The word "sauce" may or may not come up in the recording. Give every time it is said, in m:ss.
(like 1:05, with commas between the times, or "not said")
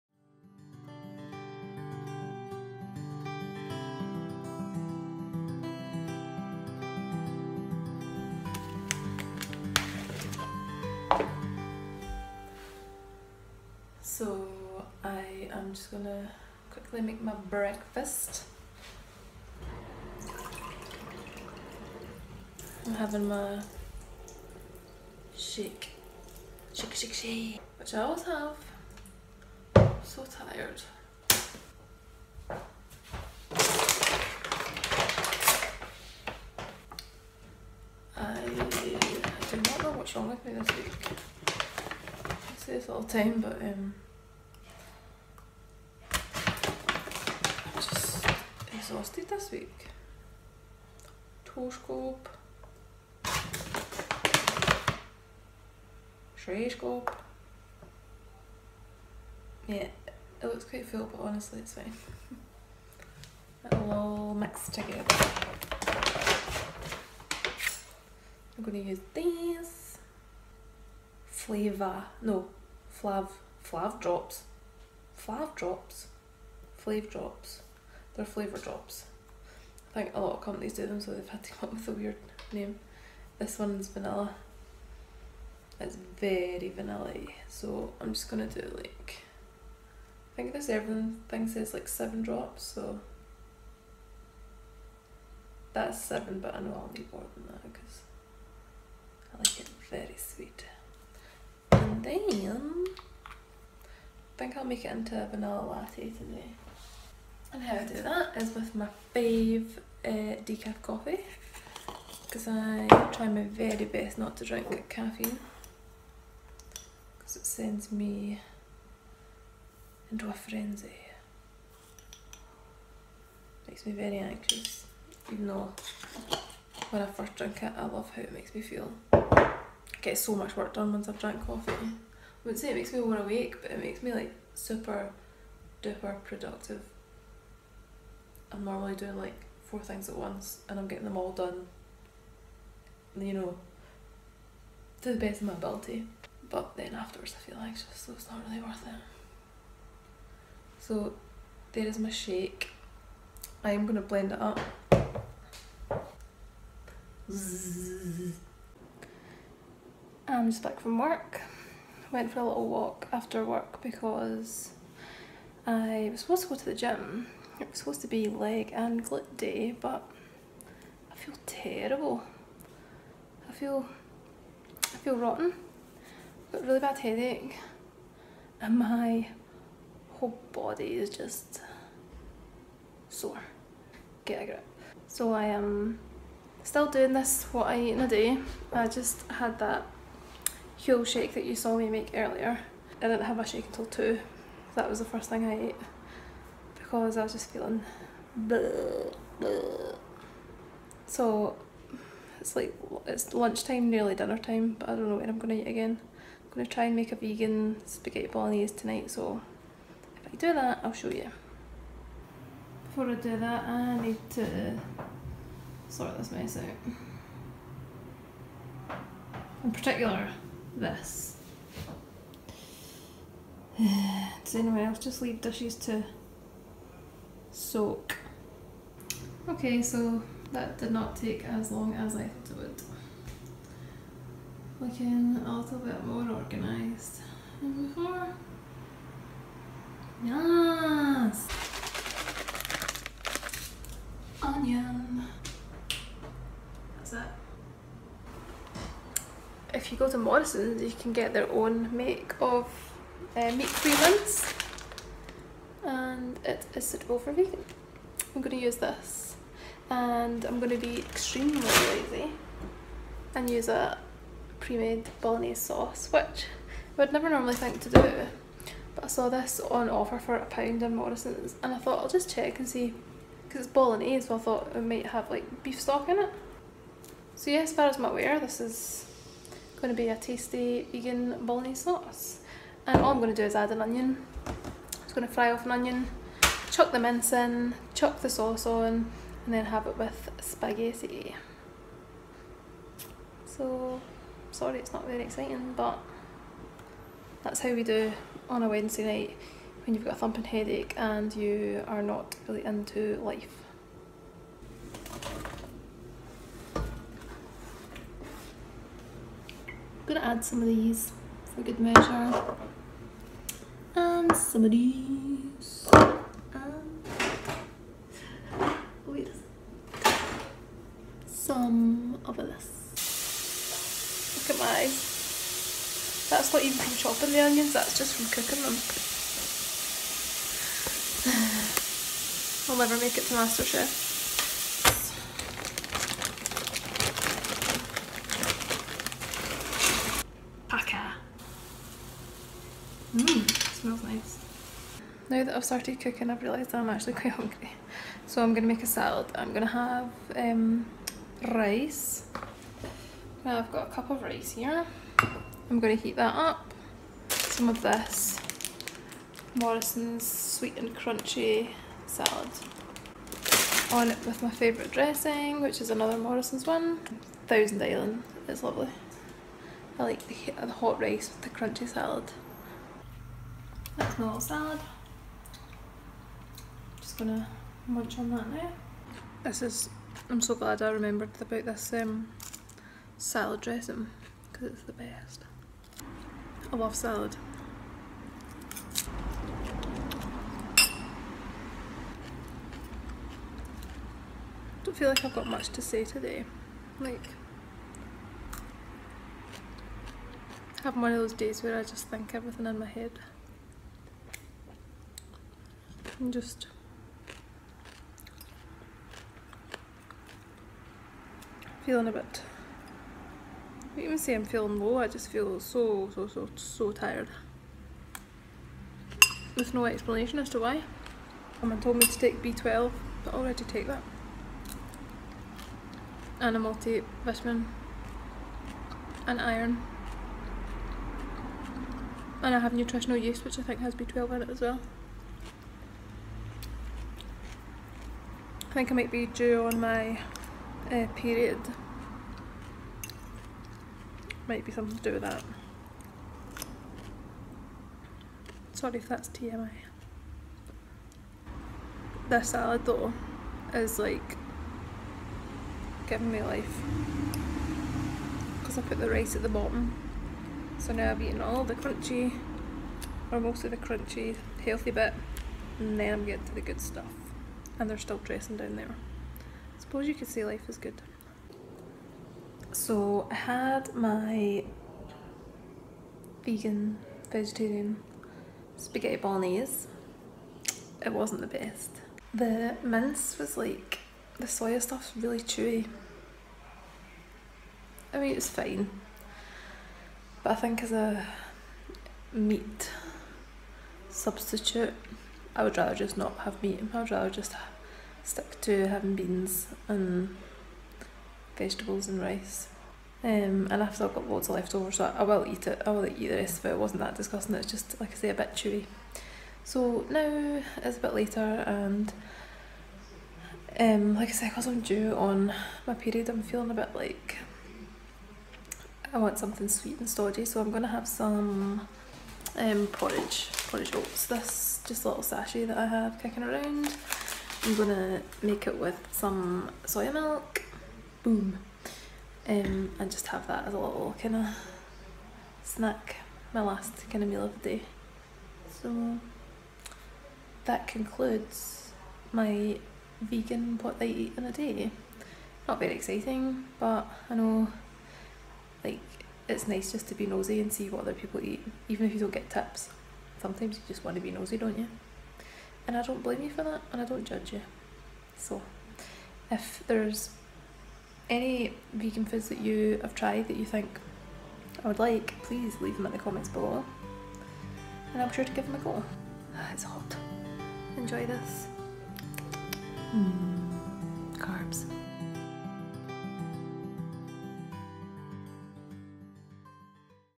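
4:25, 4:41, 4:48.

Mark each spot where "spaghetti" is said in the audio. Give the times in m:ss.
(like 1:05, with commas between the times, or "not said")
3:27, 4:50, 7:58.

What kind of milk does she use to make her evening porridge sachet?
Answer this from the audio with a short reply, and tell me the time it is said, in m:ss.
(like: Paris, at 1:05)
Soya milk, at 8:49.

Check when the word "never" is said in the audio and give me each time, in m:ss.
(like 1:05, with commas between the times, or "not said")
4:27, 5:32.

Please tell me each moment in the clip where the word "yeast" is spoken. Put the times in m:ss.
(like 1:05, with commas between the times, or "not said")
7:13.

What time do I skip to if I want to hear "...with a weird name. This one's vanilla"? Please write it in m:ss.
1:21.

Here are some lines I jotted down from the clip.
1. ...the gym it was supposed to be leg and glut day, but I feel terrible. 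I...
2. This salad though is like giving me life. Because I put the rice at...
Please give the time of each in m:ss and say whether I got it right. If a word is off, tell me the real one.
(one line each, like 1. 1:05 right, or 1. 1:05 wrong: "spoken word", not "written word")
1. 2:46 right
2. 7:32 right.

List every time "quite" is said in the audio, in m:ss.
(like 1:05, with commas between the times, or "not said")
1:00, 5:47.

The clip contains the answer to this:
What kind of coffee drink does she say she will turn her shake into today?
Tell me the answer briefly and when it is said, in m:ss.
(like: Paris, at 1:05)
Vanilla latte, at 1:45.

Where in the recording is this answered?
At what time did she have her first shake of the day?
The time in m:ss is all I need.
3:13.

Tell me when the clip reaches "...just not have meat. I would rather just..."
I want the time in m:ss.
8:15.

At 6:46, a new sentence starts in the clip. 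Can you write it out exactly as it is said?
And just feeling a bit I don't even say I'm feeling low, I just feel so, so, so, so tired.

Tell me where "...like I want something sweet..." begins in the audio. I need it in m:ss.
8:36.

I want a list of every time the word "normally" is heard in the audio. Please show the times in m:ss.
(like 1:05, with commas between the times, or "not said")
2:18, 4:27.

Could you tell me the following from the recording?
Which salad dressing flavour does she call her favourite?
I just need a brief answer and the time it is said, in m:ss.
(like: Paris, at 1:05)
Thousand Island, at 6:06.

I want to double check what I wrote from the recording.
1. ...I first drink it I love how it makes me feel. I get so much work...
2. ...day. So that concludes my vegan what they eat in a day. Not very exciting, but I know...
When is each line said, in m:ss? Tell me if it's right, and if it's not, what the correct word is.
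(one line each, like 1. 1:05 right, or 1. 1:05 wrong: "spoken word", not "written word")
1. 2:07 right
2. 8:57 right.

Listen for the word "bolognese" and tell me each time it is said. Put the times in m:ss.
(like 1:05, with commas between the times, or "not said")
3:28, 4:25, 4:33, 4:41, 7:59.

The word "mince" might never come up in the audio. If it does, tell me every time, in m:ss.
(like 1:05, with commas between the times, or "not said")
4:14, 4:46, 8:02.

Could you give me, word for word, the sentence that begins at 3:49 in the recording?
Okay, so that did not take as long as I thought it would.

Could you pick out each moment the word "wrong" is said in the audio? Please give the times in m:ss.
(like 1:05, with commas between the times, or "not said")
0:40.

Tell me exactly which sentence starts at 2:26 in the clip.
But then afterwards I feel anxious, so it's not really worth it.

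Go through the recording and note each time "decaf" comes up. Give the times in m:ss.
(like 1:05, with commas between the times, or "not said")
1:50.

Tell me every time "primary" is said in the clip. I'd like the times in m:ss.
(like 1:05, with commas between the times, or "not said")
not said.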